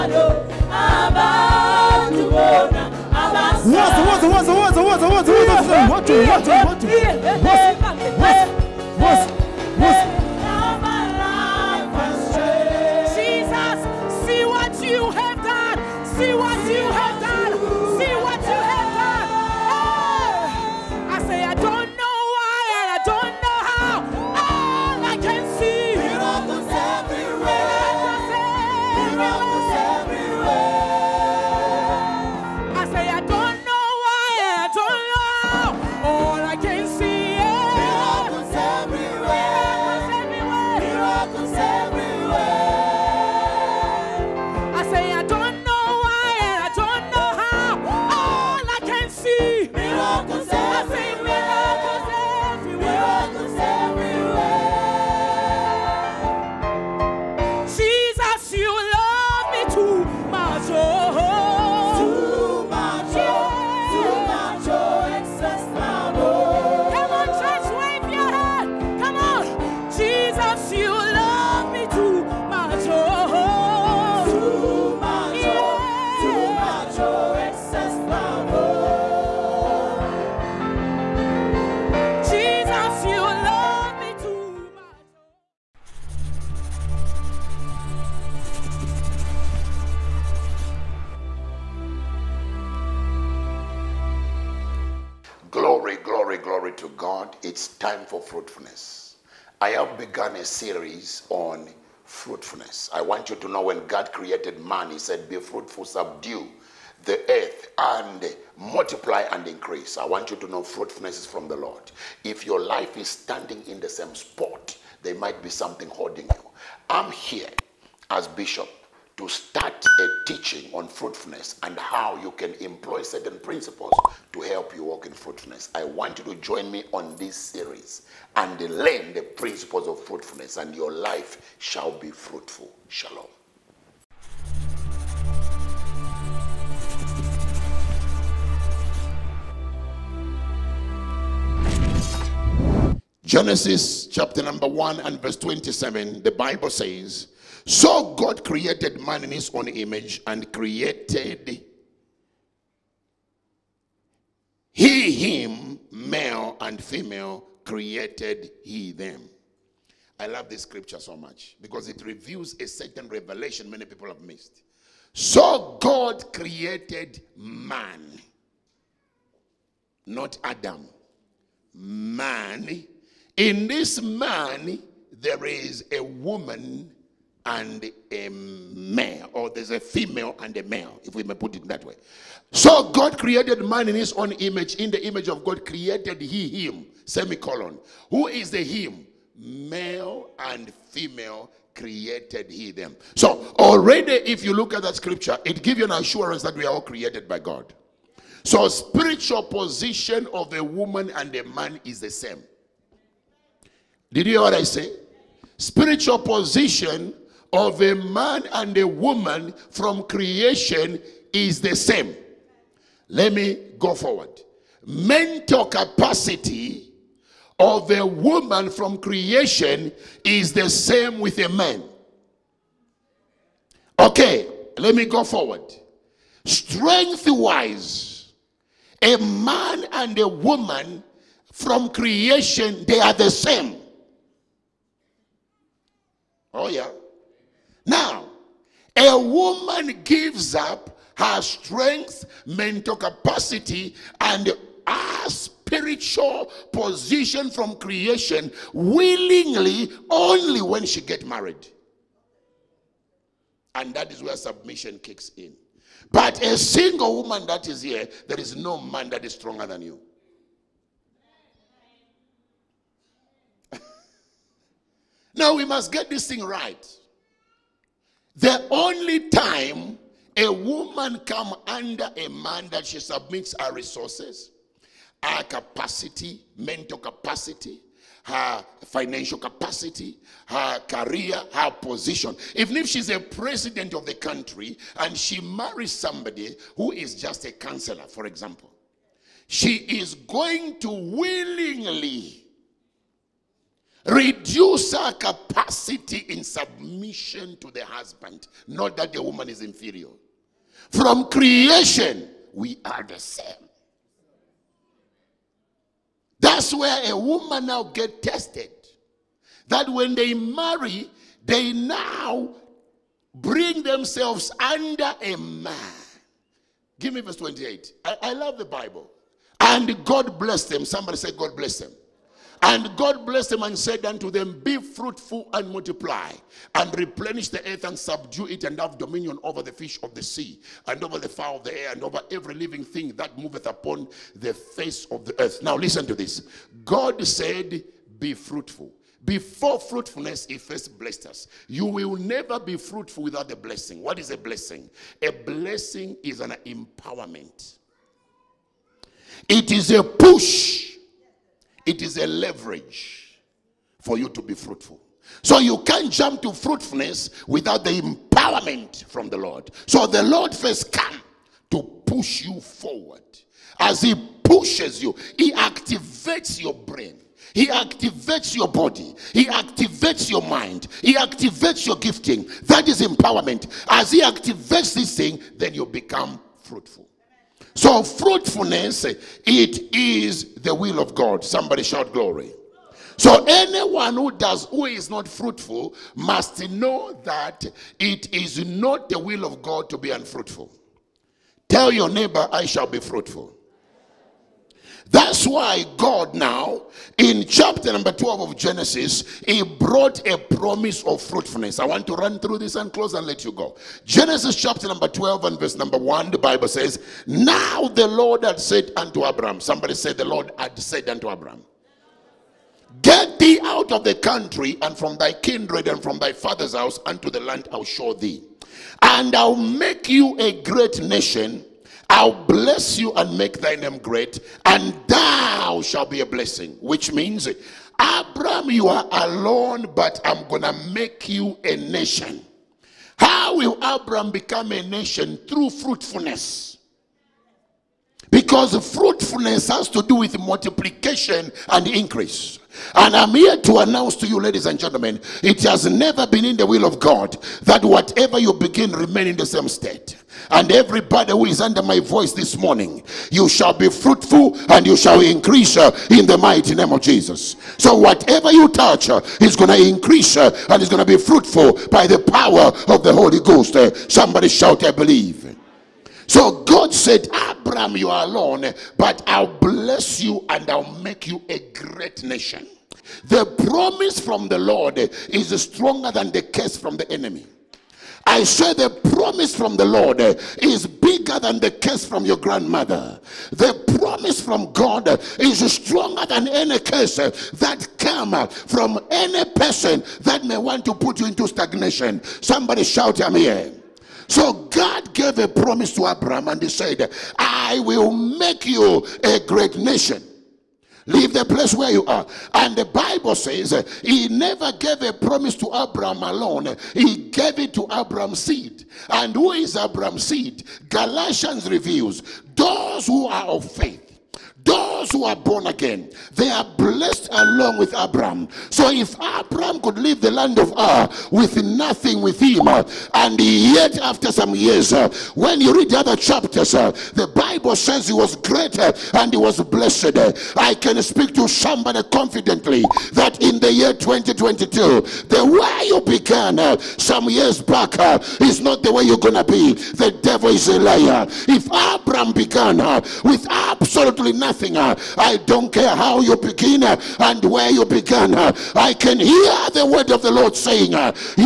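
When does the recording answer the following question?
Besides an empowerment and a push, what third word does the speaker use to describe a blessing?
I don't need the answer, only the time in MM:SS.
05:52.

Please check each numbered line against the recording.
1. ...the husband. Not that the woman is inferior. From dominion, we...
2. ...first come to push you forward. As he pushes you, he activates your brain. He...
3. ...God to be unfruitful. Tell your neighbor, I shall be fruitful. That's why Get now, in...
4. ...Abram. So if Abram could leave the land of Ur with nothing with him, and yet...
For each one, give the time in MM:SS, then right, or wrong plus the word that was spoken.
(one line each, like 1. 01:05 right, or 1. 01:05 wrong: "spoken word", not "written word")
1. 04:57 wrong: "creation", not "dominion"
2. 06:00 right
3. 06:29 wrong: "God", not "Get"
4. 08:37 right.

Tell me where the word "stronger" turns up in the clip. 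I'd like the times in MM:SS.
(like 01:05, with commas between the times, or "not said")
04:19, 07:55, 08:05.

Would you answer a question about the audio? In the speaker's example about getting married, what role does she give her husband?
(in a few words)
counselor.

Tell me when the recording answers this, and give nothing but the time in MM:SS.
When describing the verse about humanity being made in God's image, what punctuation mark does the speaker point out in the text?
03:07.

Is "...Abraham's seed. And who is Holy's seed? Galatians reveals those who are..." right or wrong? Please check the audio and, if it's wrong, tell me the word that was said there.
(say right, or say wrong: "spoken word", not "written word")
wrong: "Abraham", not "Holy".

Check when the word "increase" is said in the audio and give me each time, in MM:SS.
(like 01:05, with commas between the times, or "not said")
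01:49, 07:21, 07:35, 07:39.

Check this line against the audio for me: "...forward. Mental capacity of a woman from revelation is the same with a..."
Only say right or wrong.
wrong.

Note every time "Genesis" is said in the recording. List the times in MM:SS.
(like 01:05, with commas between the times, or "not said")
02:23, 06:38, 06:44.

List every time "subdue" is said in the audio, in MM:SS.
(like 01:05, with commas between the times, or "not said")
01:45, 05:27.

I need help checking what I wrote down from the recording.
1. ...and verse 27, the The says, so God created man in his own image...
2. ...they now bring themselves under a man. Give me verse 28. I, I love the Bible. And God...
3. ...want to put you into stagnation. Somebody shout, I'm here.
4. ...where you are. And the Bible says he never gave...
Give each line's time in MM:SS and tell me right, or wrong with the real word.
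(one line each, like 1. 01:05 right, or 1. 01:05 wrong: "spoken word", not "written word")
1. 02:24 wrong: "Bible", not "The"
2. 05:11 right
3. 08:10 right
4. 08:21 right.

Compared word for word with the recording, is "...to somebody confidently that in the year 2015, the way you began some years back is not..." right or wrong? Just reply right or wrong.
wrong.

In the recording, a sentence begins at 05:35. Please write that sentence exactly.
Now, listen to this God said, Be fruitful.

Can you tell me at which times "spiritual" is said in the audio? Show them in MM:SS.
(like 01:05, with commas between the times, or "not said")
03:18, 03:25, 04:05.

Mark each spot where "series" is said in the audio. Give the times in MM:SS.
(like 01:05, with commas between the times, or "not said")
01:40, 02:07.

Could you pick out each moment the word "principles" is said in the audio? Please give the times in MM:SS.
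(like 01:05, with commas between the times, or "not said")
02:03, 02:09.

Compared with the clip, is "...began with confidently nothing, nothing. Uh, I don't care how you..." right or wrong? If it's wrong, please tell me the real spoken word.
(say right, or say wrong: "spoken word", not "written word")
wrong: "absolutely", not "confidently".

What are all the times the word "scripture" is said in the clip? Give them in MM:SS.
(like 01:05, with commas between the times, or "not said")
02:40, 03:14.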